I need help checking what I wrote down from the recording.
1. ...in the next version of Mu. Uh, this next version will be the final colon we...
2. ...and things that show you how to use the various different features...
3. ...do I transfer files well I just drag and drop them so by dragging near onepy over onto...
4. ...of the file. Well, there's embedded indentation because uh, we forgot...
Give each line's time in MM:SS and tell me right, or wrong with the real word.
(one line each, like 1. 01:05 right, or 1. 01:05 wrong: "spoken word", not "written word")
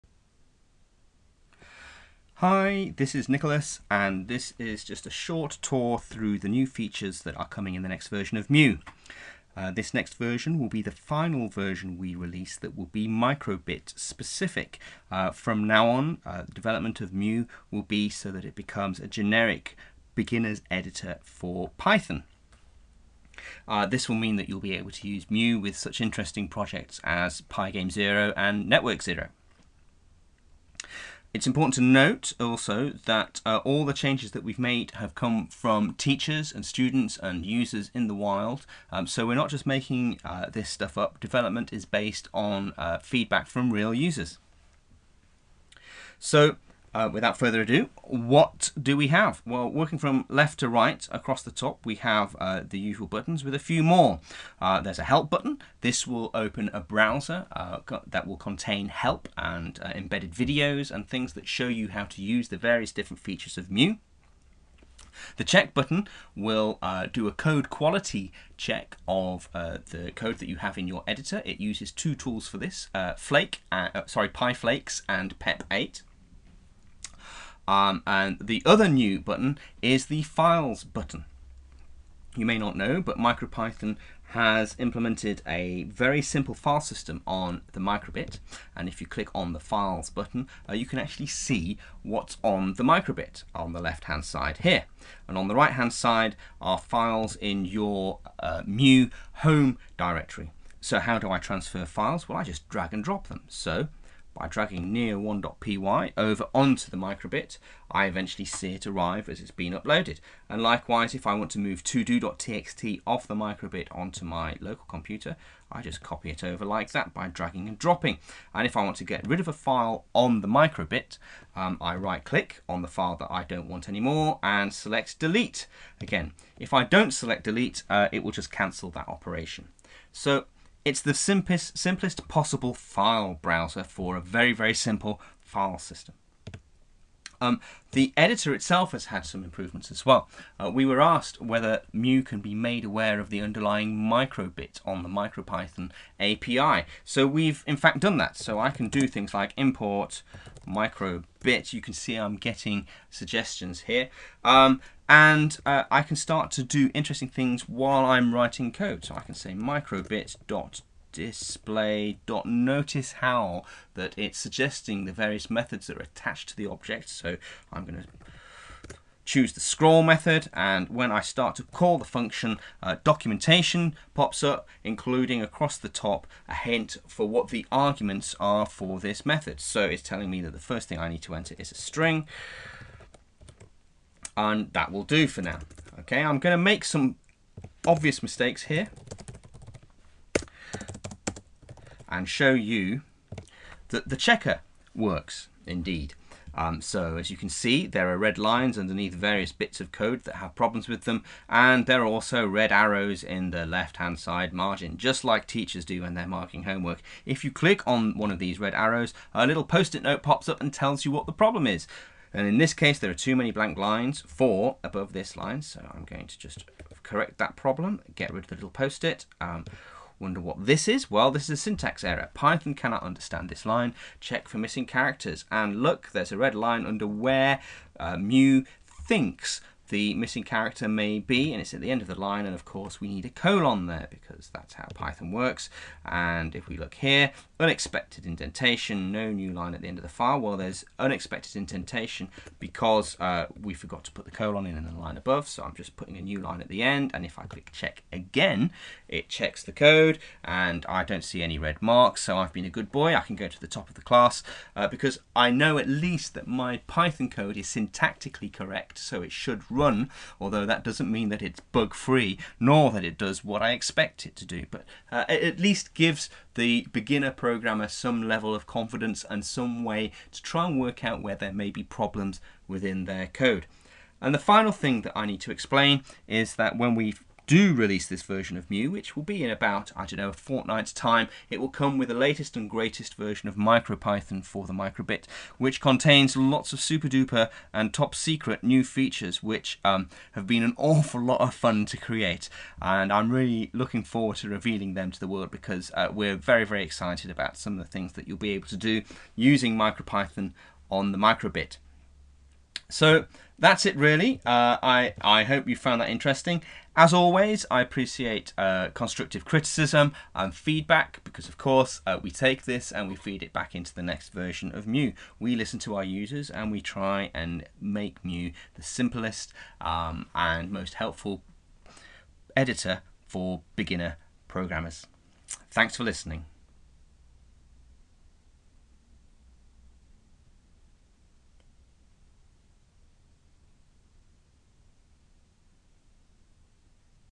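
1. 00:07 wrong: "version", not "colon"
2. 01:00 right
3. 01:41 right
4. 03:59 wrong: "unexpected", not "embedded".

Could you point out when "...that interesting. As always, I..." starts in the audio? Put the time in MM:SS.
05:06.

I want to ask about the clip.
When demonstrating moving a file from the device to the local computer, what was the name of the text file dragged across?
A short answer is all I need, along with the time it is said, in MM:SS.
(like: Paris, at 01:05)
todo.txt, at 01:51.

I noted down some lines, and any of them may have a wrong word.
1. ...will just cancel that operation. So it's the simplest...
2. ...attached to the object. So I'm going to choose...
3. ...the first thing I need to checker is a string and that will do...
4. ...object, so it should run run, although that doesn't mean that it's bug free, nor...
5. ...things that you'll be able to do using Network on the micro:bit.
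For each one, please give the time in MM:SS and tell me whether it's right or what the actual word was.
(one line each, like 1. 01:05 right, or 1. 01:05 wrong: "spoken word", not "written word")
1. 02:08 right
2. 02:46 right
3. 03:00 wrong: "enter", not "checker"
4. 04:18 wrong: "correct", not "object"
5. 04:57 wrong: "MicroPython", not "Network".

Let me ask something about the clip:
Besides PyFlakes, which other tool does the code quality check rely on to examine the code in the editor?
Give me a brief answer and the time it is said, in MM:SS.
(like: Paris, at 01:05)
PEP8, at 01:15.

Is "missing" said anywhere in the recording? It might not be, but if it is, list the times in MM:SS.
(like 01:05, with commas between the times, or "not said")
03:44, 03:50.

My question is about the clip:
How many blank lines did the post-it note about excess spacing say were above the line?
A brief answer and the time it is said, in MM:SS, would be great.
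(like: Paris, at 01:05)
4, at 03:34.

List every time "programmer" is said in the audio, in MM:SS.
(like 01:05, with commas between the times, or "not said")
04:27, 05:24.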